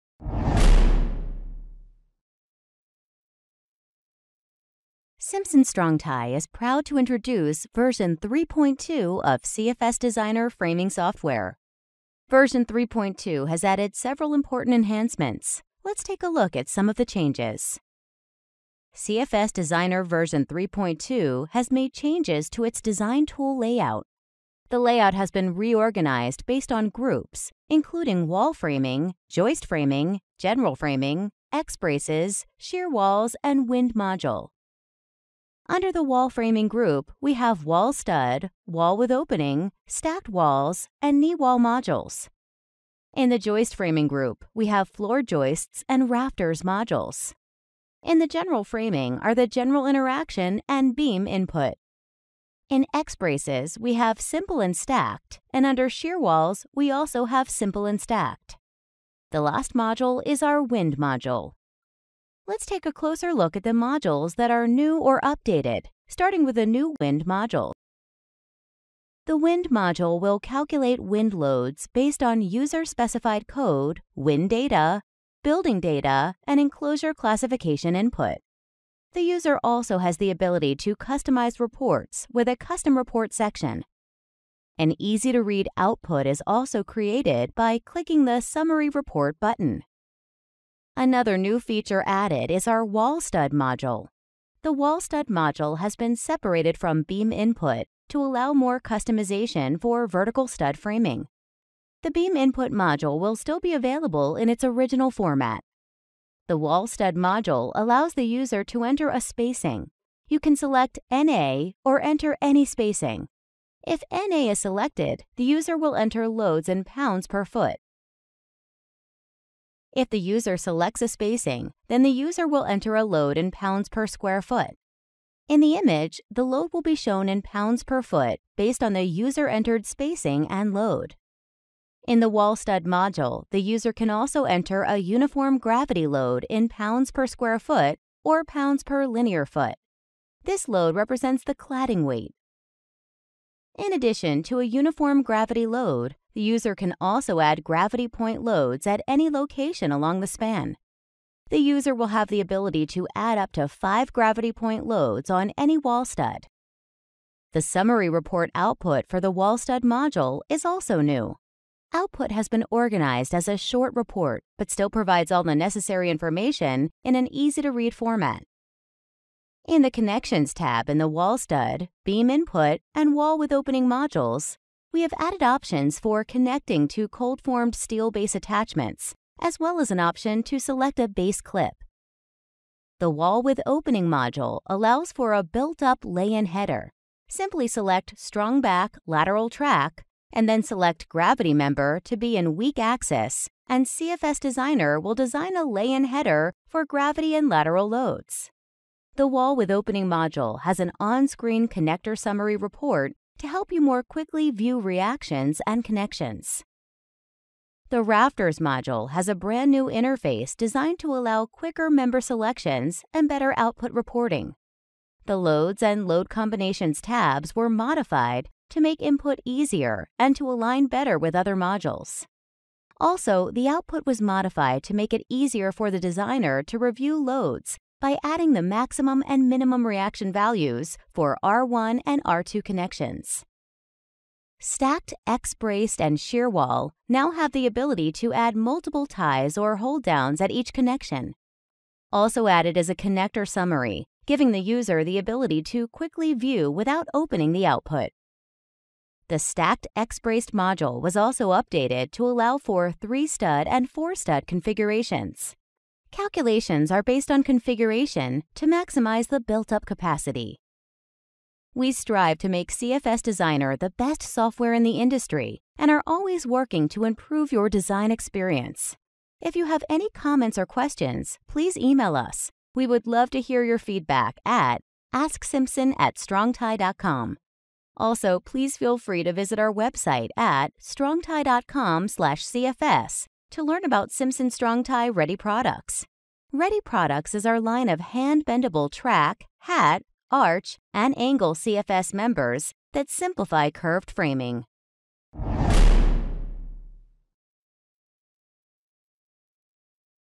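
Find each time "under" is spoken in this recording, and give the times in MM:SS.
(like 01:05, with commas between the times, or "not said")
00:35, 00:55.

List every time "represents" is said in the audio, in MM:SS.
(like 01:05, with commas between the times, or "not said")
02:20.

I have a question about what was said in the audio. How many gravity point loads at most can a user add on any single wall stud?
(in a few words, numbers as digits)
5.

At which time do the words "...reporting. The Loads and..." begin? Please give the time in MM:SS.
03:33.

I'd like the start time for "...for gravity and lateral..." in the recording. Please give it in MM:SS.
03:16.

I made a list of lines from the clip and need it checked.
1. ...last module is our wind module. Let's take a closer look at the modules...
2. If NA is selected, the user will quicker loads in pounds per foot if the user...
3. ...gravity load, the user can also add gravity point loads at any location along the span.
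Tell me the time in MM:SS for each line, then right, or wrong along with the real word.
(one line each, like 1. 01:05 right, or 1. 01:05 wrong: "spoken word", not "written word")
1. 00:59 right
2. 01:53 wrong: "enter", not "quicker"
3. 02:25 right.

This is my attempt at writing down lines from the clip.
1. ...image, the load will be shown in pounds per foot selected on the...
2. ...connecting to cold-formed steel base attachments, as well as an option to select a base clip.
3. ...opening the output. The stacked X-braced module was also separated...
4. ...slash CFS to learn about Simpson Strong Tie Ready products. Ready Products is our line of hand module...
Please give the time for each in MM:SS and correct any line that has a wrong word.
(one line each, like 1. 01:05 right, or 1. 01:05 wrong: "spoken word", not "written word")
1. 02:05 wrong: "based", not "selected"
2. 02:56 right
3. 04:07 wrong: "updated", not "separated"
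4. 04:42 wrong: "bendable", not "module".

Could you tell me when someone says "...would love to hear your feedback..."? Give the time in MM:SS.
04:32.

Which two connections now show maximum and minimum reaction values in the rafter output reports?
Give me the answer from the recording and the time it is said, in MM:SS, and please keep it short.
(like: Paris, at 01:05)
R1 and R2, at 03:51.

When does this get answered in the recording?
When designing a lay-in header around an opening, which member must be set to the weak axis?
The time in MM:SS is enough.
03:11.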